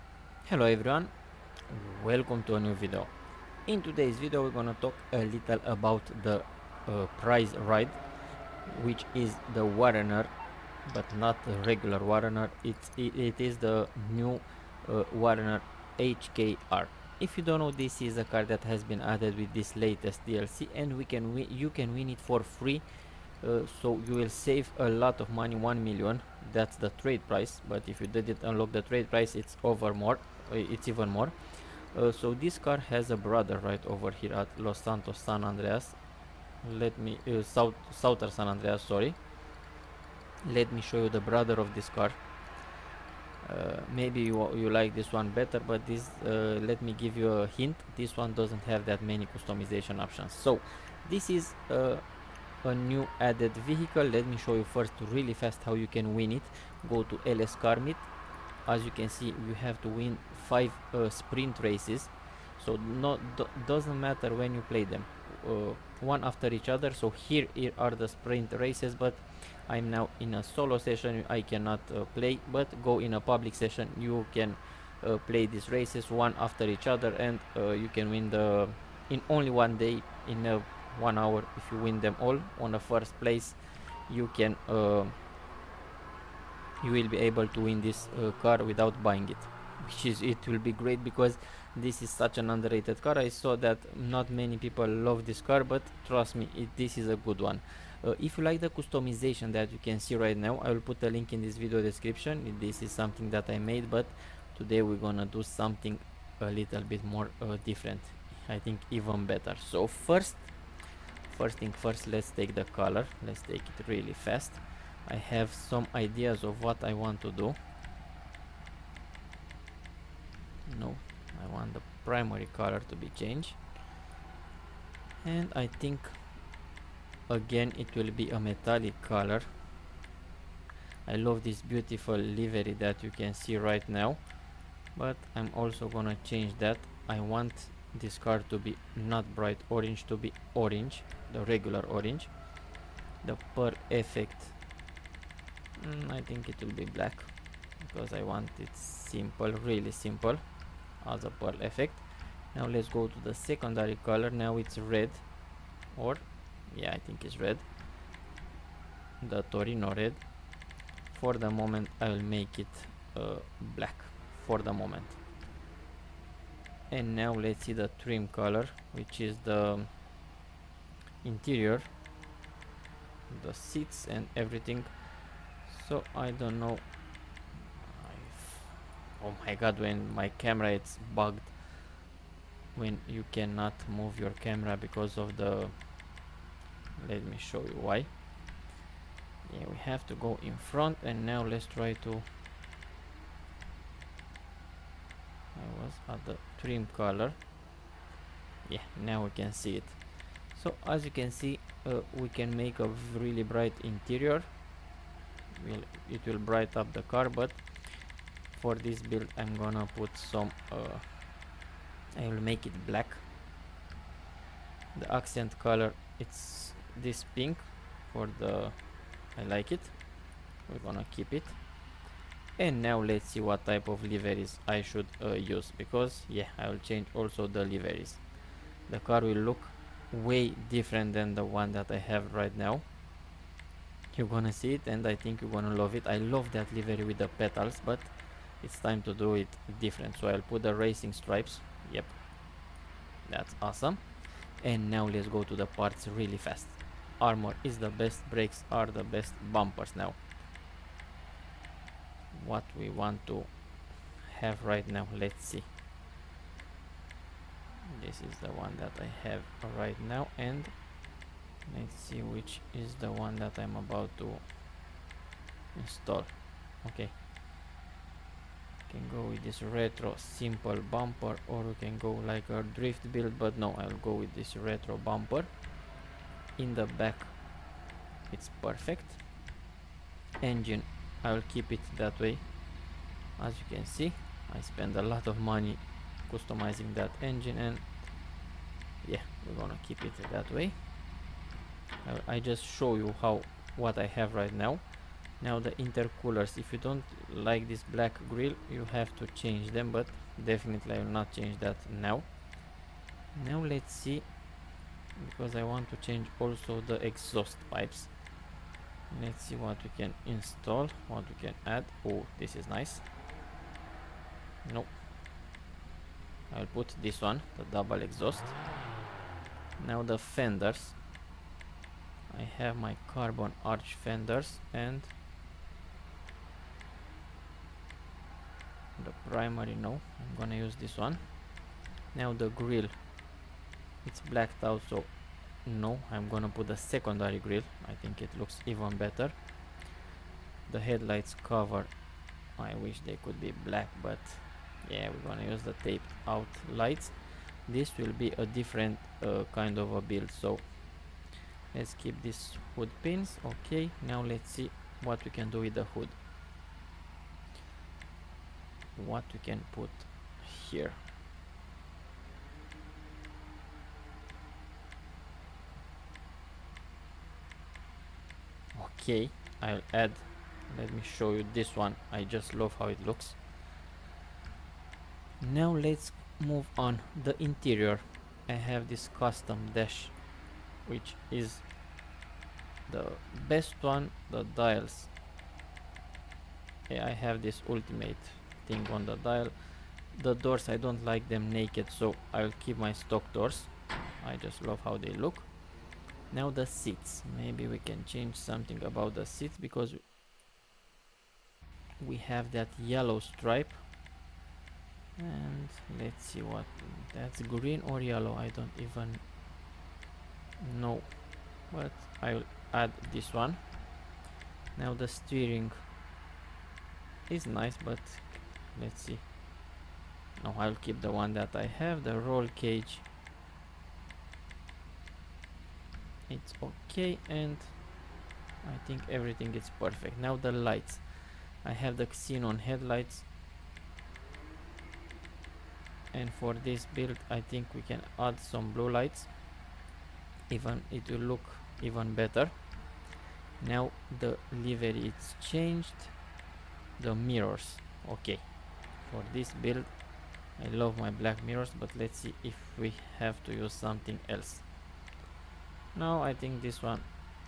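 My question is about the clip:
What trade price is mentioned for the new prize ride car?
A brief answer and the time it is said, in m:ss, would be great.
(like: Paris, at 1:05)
1 million, at 0:25.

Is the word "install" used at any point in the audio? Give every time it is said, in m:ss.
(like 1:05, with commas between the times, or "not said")
4:25, 5:10.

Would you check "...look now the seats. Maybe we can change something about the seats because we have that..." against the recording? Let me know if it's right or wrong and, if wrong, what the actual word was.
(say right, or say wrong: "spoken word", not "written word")
right.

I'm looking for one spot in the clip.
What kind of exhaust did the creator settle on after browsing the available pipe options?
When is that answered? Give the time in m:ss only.
5:17.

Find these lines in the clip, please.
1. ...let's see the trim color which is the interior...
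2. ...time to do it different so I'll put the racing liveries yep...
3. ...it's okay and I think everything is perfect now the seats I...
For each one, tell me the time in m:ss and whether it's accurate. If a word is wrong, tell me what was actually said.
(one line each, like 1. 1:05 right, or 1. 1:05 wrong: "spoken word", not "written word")
1. 2:47 right
2. 3:58 wrong: "stripes", not "liveries"
3. 7:06 wrong: "lights", not "seats".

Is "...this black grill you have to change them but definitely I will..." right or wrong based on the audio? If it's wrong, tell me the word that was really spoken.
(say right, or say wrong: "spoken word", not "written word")
right.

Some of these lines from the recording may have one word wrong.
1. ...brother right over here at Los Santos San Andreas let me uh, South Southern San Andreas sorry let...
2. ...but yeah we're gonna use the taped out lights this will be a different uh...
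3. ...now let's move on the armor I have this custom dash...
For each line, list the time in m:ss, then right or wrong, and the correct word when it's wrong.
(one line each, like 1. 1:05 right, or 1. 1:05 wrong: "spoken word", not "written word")
1. 0:33 right
2. 5:44 right
3. 6:15 wrong: "interior", not "armor".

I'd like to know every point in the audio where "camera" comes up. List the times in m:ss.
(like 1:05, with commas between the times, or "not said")
3:00, 3:04.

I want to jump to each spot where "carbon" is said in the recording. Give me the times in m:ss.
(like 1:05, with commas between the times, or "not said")
5:23.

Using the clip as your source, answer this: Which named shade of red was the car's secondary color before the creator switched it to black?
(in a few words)
Torino red.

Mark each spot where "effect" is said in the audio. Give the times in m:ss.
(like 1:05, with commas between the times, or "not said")
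2:23, 2:31.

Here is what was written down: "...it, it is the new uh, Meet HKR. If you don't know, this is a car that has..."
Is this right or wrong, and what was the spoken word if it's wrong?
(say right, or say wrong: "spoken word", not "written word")
wrong: "Warrener", not "Meet".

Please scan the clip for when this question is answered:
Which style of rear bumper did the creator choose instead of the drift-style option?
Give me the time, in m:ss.
4:34.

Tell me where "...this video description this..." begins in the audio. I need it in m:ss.
1:41.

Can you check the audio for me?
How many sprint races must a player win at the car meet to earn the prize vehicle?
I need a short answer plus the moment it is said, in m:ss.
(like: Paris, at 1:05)
5, at 1:00.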